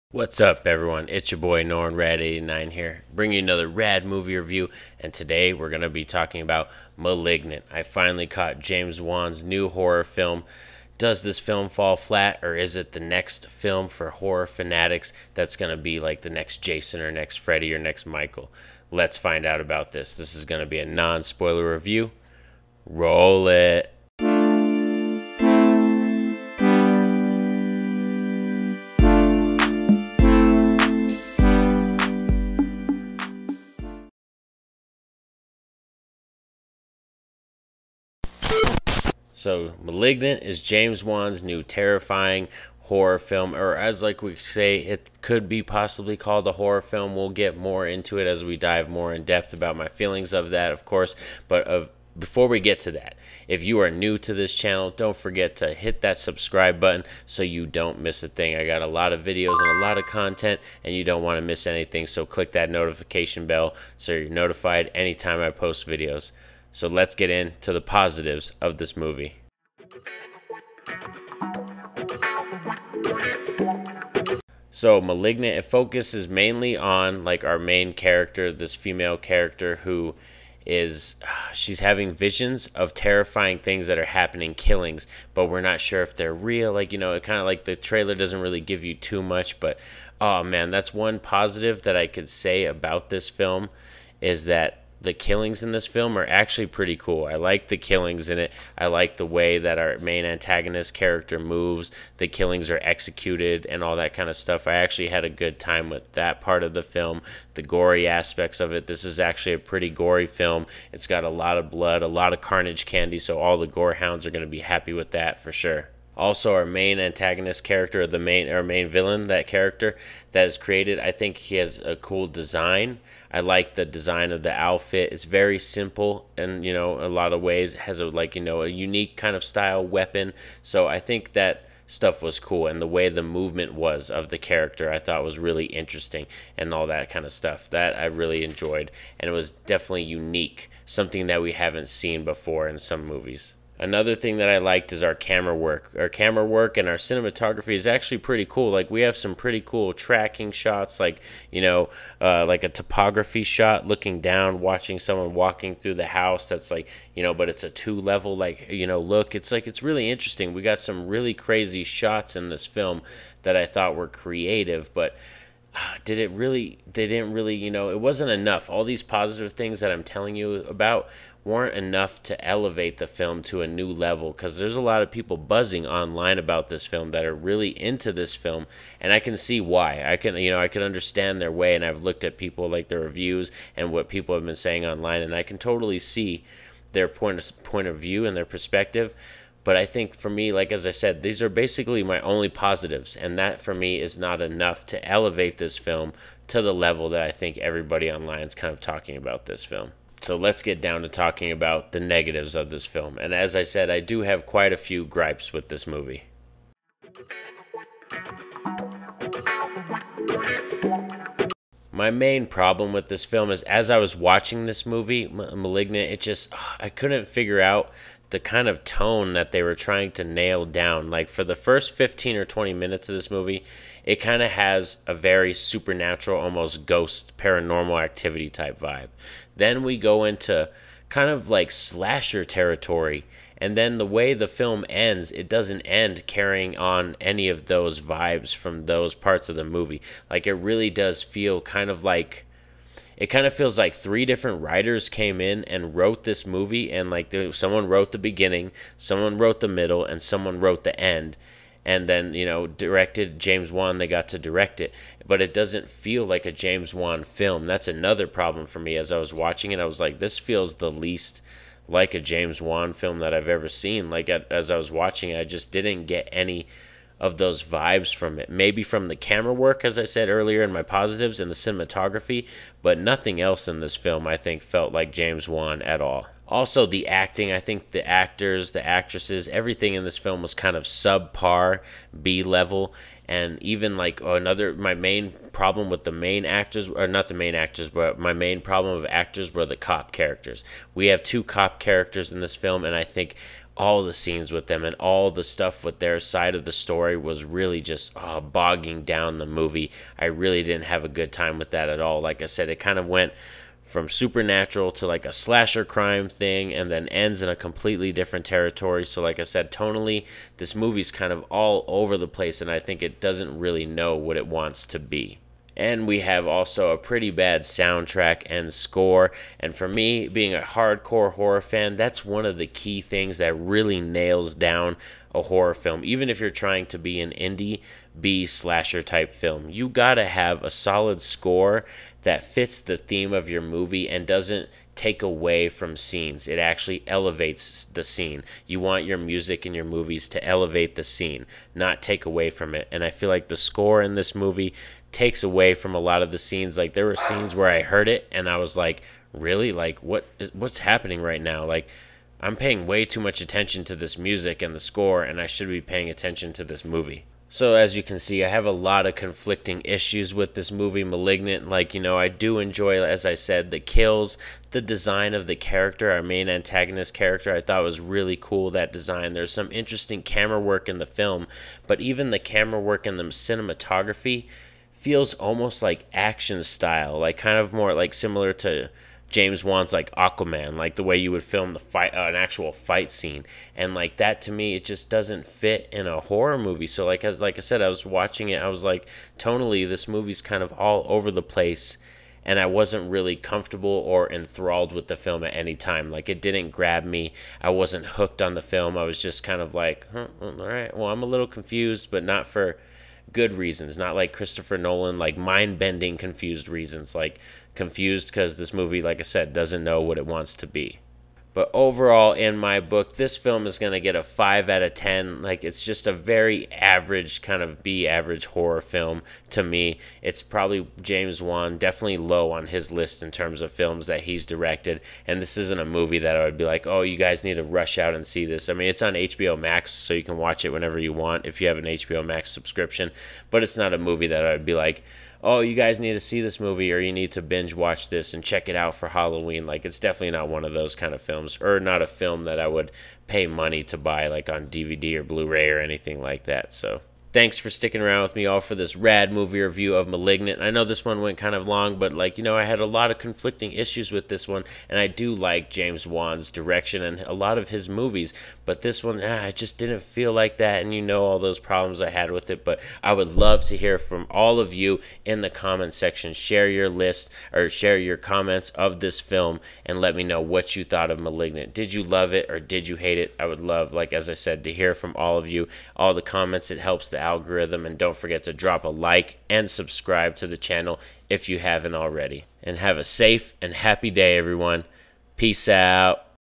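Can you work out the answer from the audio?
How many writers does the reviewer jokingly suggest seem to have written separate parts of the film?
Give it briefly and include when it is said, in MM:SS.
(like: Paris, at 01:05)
three, at 04:03.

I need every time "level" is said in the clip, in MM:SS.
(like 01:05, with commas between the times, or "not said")
02:37, 02:53, 03:16, 04:42.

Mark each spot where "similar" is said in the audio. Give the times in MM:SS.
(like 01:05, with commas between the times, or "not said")
06:18.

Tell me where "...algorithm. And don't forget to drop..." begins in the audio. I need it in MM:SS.
07:57.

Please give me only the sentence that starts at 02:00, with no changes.
I think he has a cool design.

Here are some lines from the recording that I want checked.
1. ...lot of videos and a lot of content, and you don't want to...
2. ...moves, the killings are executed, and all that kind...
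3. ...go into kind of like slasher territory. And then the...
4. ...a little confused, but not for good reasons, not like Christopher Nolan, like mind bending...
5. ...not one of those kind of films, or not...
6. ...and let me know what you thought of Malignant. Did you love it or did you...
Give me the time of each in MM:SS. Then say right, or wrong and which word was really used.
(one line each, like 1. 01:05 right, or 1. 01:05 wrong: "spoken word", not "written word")
1. 00:58 right
2. 01:41 right
3. 03:49 right
4. 06:41 right
5. 07:20 right
6. 07:49 right.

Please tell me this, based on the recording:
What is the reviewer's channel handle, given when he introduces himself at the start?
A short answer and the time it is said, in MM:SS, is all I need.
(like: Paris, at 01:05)
Norin Radd 89, at 00:01.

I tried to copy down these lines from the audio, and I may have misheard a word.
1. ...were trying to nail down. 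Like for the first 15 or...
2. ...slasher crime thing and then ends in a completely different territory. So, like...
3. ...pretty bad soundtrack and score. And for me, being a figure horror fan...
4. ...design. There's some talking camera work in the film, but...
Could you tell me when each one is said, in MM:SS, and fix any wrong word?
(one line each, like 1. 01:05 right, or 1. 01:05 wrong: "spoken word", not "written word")
1. 03:39 right
2. 05:05 right
3. 05:16 wrong: "hardcore", not "figure"
4. 06:08 wrong: "interesting", not "talking".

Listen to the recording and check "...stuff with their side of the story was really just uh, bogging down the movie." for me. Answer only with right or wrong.
right.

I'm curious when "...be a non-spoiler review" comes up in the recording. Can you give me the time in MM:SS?
00:20.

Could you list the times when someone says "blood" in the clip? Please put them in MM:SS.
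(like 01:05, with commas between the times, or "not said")
01:51.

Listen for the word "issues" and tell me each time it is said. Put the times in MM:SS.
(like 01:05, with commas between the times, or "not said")
05:59, 07:33.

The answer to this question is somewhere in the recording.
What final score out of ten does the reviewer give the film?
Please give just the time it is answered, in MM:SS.
06:54.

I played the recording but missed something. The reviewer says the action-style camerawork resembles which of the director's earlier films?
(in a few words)
Aquaman.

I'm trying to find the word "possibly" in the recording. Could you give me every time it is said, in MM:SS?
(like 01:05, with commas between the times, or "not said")
00:45.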